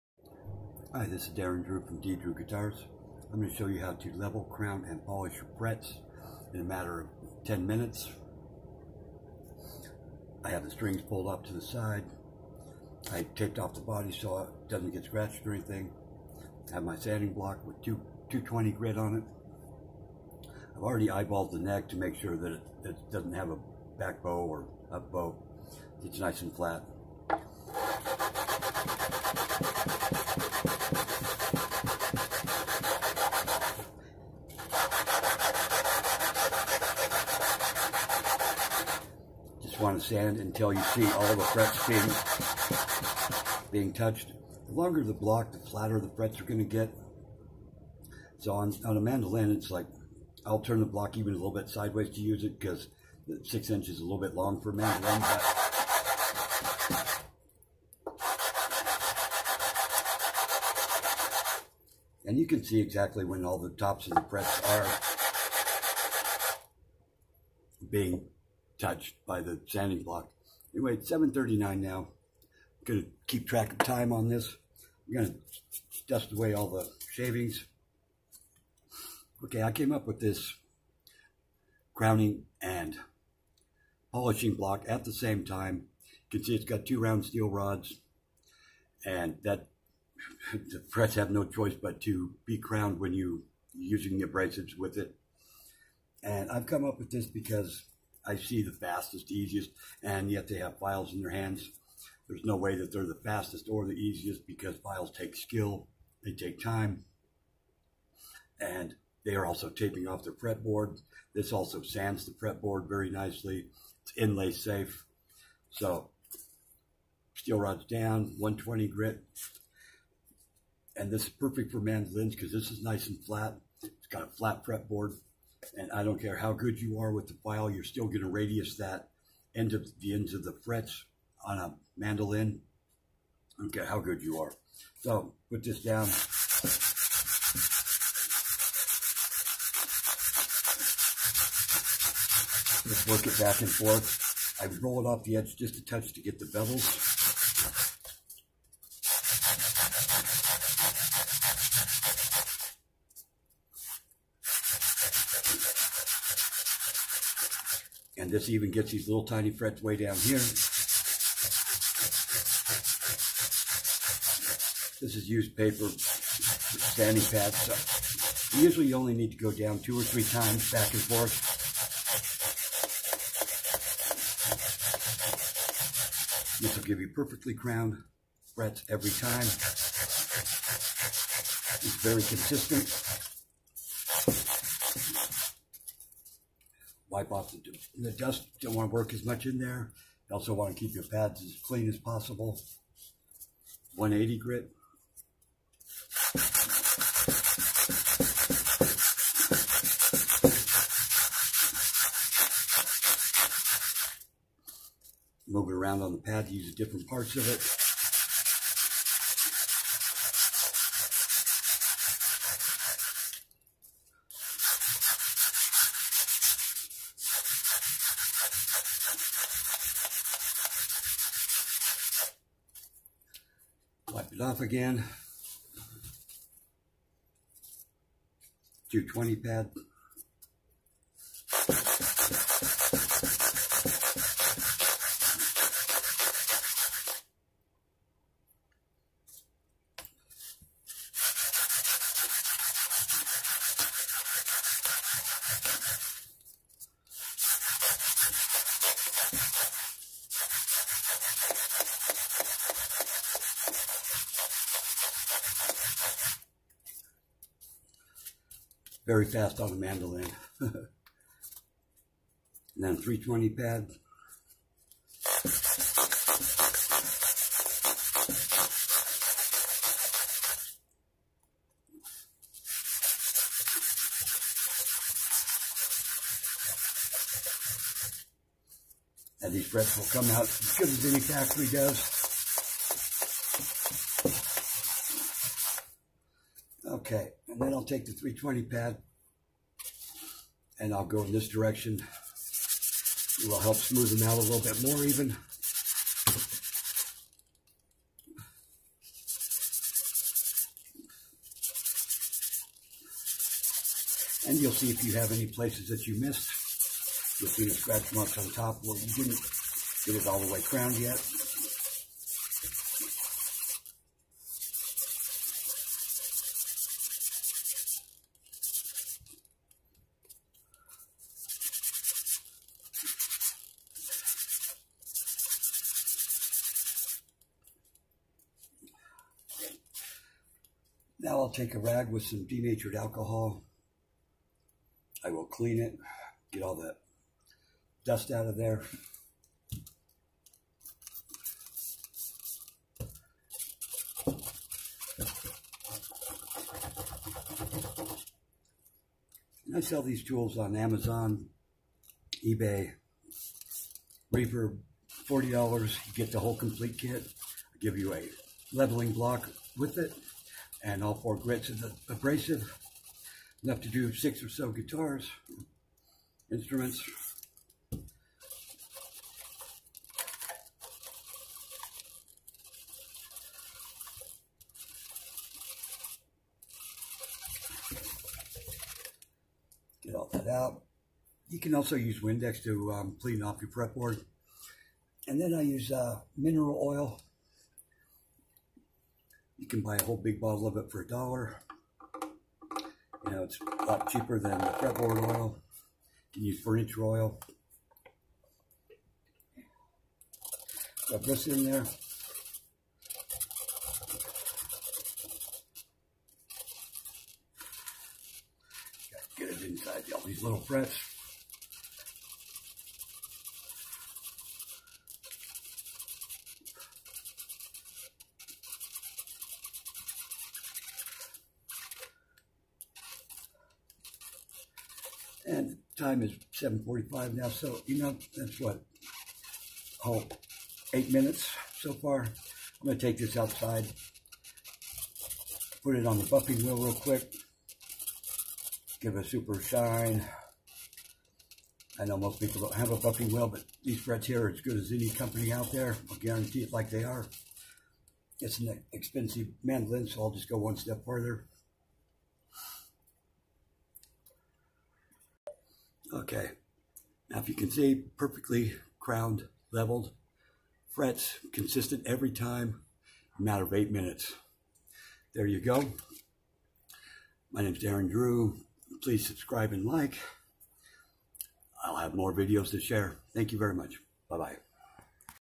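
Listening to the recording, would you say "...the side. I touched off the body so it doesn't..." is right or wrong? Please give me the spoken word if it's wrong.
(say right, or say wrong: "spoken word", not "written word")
wrong: "taped", not "touched".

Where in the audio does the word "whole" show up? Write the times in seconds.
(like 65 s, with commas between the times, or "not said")
356 s, 390 s.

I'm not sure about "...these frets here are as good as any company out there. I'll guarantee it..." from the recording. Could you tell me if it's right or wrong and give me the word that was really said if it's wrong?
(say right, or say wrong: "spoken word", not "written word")
right.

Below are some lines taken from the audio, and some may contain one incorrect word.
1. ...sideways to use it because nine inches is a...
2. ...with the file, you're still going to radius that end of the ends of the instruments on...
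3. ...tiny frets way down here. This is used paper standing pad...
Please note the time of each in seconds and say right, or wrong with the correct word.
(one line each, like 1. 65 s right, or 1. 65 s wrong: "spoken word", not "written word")
1. 51 s wrong: "six", not "nine"
2. 127 s wrong: "frets", not "instruments"
3. 159 s right.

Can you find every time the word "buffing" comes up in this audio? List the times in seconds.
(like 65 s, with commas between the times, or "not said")
436 s, 442 s.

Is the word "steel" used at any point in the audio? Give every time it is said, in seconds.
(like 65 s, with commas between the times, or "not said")
87 s, 117 s.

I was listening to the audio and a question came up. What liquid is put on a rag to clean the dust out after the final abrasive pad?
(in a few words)
Denatured alcohol.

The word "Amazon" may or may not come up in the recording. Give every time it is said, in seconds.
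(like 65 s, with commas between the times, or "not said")
350 s.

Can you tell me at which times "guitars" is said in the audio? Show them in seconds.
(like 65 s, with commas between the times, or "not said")
2 s, 364 s.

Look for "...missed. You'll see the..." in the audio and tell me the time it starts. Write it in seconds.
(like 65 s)
306 s.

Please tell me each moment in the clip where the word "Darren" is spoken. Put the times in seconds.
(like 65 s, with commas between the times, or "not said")
1 s, 467 s.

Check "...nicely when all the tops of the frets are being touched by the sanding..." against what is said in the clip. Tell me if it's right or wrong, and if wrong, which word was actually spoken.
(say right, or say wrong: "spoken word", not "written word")
wrong: "exactly", not "nicely".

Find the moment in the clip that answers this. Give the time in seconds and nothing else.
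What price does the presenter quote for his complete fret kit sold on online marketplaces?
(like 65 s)
355 s.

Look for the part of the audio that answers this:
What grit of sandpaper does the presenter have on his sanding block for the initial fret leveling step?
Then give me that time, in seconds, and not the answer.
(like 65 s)
18 s.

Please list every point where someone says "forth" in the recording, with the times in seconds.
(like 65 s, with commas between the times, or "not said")
143 s, 171 s.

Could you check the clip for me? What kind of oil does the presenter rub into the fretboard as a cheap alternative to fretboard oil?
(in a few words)
Mineral oil.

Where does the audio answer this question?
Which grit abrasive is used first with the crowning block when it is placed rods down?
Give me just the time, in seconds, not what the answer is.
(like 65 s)
118 s.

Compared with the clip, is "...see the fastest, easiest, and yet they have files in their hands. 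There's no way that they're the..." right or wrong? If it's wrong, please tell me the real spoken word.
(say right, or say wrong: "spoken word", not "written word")
right.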